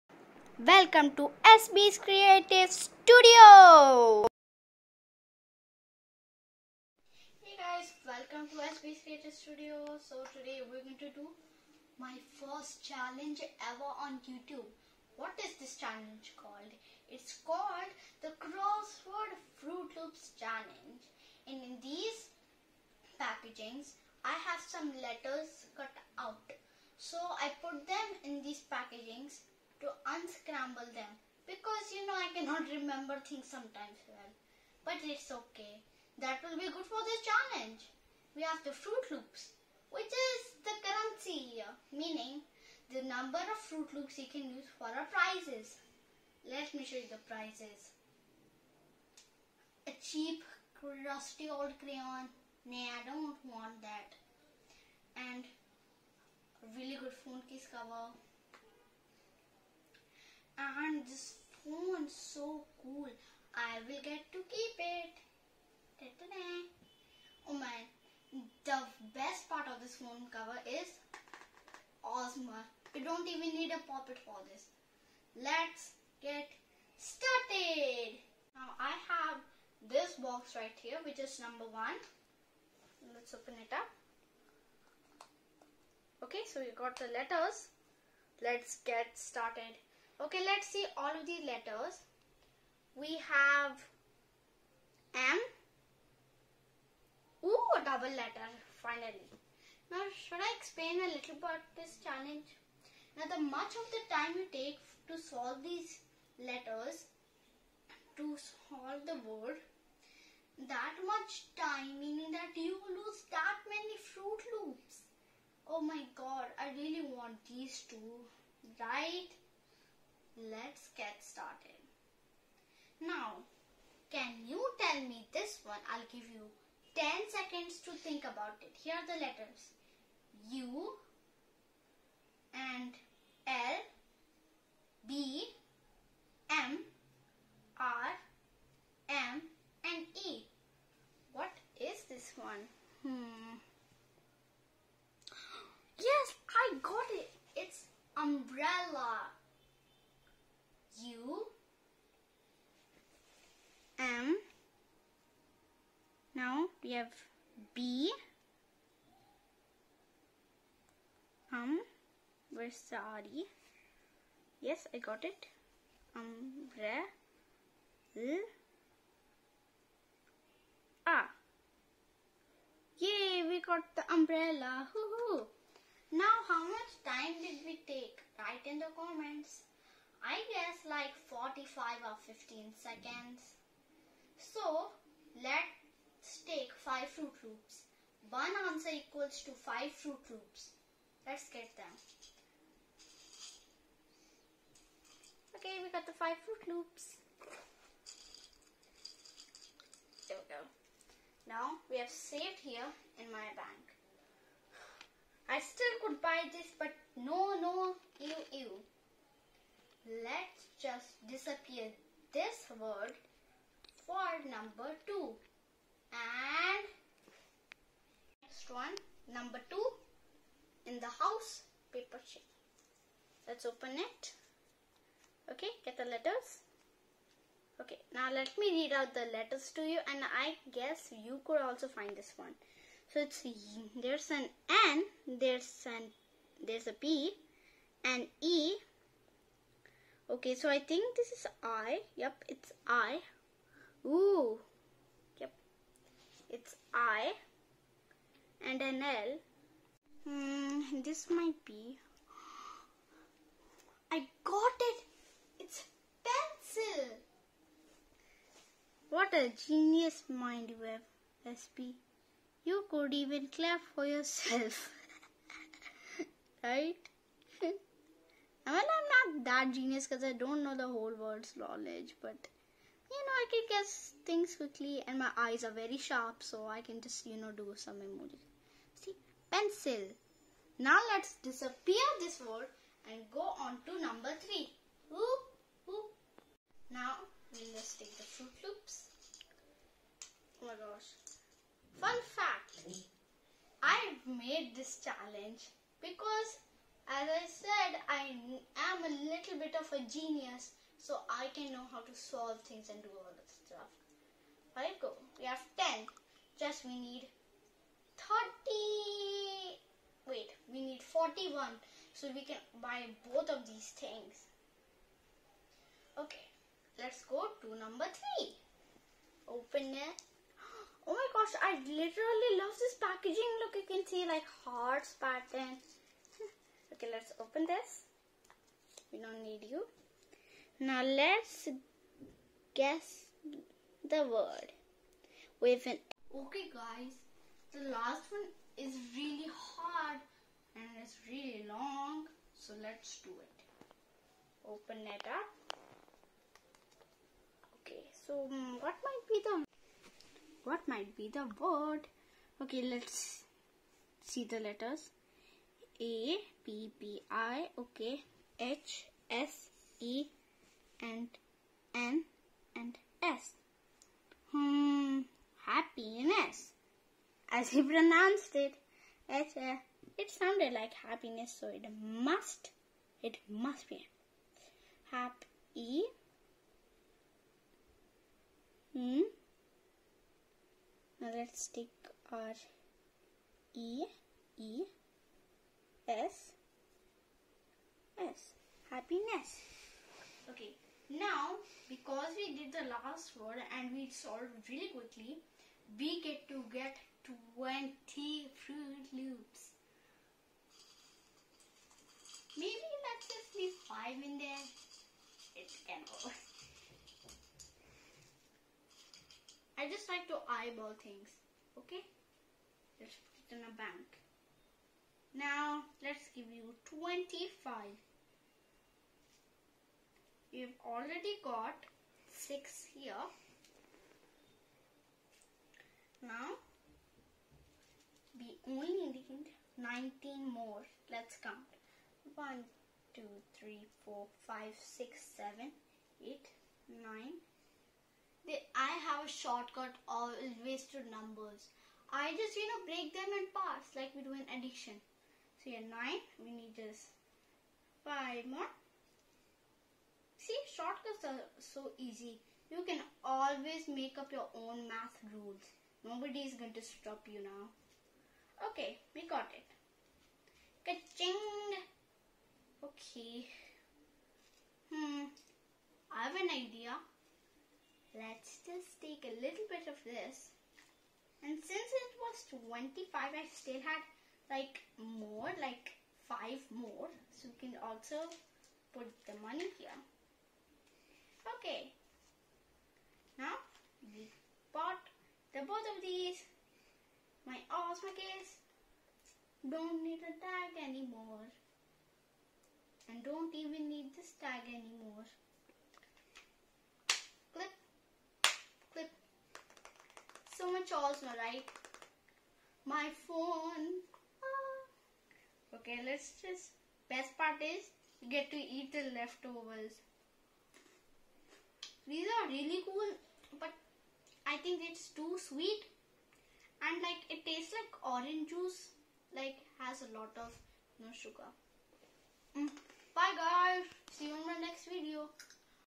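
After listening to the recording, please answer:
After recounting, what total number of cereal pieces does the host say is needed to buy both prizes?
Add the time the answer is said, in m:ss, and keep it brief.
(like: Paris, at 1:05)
41, at 5:10.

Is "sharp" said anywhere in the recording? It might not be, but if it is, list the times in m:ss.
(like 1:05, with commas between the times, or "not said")
4:35.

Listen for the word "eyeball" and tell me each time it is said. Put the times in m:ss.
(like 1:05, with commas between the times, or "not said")
6:50.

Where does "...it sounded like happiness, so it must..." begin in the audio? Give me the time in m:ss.
6:10.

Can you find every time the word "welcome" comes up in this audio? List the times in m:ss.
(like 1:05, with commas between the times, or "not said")
0:00, 0:08.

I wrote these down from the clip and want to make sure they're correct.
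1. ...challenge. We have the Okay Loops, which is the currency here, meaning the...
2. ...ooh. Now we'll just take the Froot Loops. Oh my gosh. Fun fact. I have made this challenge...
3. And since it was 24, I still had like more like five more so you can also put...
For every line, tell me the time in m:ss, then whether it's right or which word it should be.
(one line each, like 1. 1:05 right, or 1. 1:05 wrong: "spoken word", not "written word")
1. 0:37 wrong: "Froot", not "Okay"
2. 4:45 right
3. 7:51 wrong: "25", not "24".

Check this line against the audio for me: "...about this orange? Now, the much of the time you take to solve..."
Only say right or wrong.
wrong.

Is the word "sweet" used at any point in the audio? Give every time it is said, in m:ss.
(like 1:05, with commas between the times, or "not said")
8:35.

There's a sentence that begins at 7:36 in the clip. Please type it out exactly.
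Nobody is going to stop you now.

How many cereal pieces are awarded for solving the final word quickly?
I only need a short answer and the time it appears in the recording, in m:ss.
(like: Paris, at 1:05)
20, at 6:37.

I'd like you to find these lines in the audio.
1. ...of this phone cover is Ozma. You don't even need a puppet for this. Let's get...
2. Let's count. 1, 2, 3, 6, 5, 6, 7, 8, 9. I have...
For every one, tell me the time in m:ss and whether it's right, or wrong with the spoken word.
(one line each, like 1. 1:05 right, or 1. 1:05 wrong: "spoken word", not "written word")
1. 1:09 right
2. 7:11 wrong: "4", not "6".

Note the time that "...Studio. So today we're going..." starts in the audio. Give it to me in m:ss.
0:09.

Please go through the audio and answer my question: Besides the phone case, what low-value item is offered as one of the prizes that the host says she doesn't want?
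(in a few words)
crayon.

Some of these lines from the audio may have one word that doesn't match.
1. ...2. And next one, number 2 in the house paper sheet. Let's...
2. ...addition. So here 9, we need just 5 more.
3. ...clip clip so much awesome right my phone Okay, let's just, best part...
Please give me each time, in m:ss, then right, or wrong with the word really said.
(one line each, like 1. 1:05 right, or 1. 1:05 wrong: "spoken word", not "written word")
1. 3:35 right
2. 7:24 right
3. 8:17 right.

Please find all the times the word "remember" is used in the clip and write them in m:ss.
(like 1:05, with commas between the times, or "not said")
0:32.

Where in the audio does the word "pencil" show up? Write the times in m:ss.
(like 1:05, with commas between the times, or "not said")
4:16, 4:39.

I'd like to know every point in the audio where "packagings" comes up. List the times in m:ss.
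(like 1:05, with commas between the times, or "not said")
0:23, 0:28, 5:23.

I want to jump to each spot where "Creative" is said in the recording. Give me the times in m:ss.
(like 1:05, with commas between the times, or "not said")
0:01, 0:09.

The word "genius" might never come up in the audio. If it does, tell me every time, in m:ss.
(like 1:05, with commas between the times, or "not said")
4:19, 4:29, 5:00.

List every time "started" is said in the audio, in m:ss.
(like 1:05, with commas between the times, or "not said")
1:16, 1:29, 2:01.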